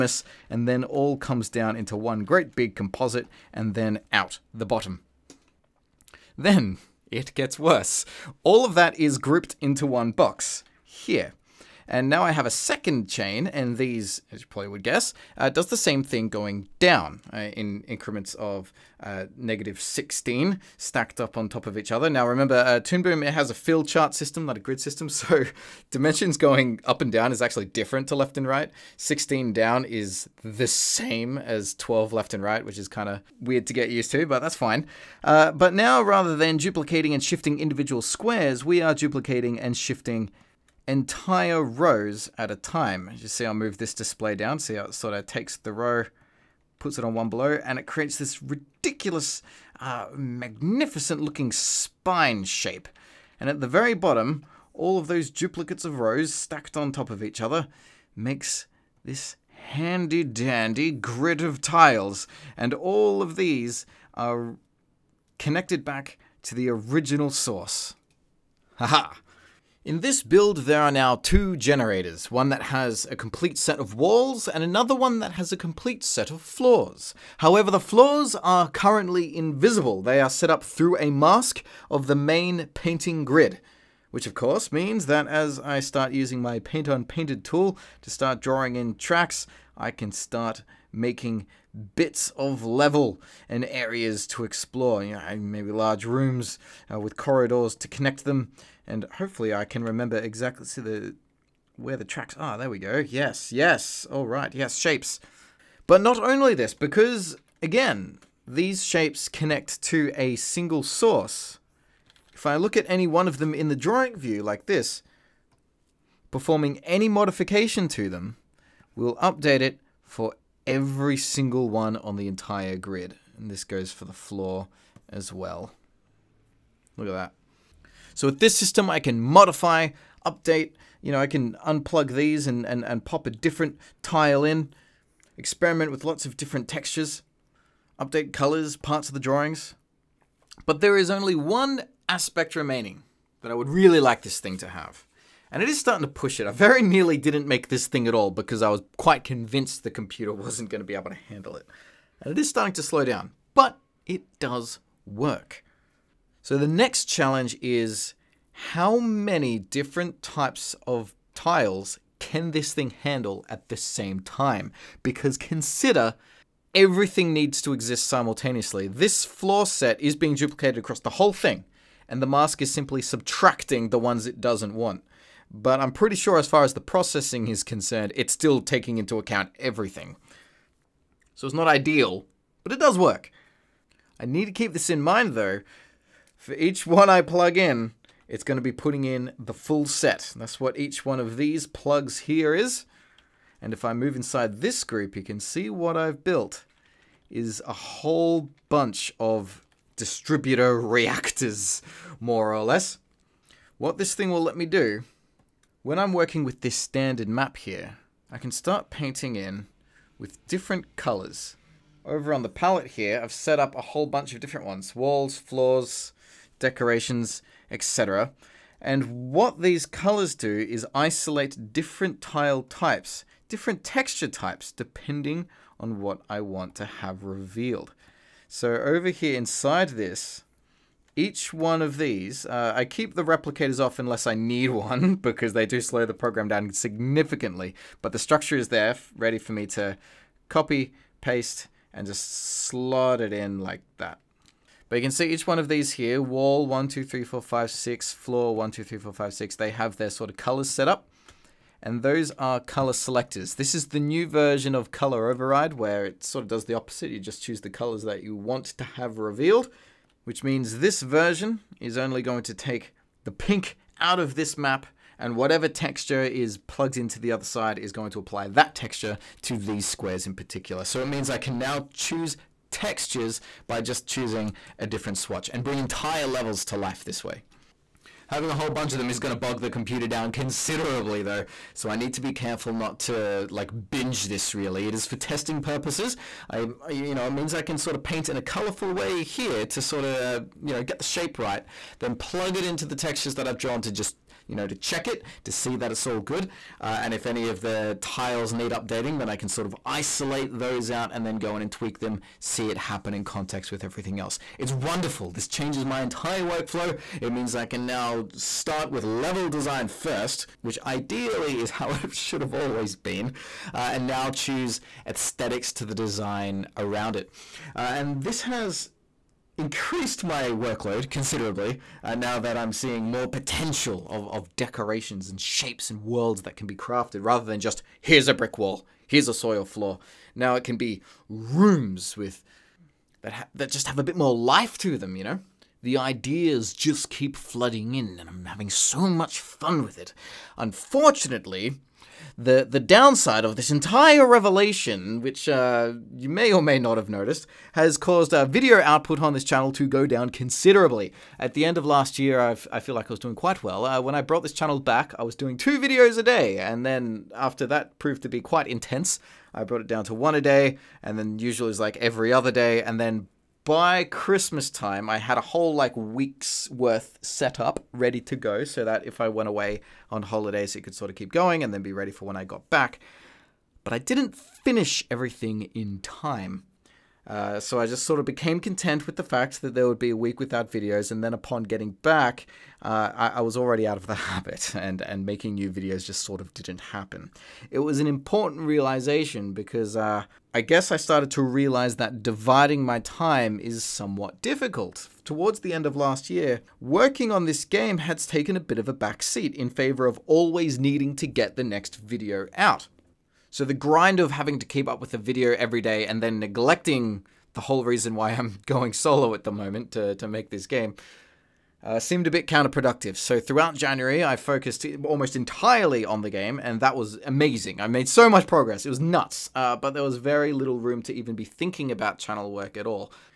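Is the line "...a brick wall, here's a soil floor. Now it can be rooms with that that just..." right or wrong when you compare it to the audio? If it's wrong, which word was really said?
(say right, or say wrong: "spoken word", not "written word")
right.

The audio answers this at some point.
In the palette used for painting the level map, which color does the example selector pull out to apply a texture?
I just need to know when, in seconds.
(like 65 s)
263 s.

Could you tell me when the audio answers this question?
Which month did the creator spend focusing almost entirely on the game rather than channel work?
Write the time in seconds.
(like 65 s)
413 s.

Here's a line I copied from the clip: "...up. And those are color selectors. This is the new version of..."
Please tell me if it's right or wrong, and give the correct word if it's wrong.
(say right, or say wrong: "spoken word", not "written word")
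right.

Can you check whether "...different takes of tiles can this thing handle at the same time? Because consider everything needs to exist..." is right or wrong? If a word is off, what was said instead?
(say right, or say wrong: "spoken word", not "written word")
wrong: "types", not "takes".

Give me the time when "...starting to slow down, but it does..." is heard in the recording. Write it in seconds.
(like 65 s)
152 s.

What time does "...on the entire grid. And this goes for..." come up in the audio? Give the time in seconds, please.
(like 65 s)
121 s.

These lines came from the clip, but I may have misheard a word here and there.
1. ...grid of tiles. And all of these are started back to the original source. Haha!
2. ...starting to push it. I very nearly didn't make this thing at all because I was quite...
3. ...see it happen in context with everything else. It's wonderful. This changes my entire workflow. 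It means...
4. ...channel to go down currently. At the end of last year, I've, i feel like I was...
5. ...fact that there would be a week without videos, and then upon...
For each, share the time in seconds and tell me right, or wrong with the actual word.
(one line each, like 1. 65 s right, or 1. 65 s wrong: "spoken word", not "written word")
1. 60 s wrong: "connected", not "started"
2. 145 s right
3. 302 s right
4. 349 s wrong: "considerably", not "currently"
5. 379 s right.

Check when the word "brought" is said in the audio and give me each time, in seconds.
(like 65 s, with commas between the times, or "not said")
354 s, 359 s.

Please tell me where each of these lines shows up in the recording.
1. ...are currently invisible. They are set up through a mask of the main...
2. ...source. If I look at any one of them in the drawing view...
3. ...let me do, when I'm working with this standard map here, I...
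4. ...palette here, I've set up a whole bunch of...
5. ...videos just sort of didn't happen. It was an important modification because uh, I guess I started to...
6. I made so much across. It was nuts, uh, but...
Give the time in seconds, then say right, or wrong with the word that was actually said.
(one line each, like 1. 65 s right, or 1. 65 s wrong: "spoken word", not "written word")
1. 78 s right
2. 110 s right
3. 204 s right
4. 212 s right
5. 385 s wrong: "realization", not "modification"
6. 417 s wrong: "progress", not "across".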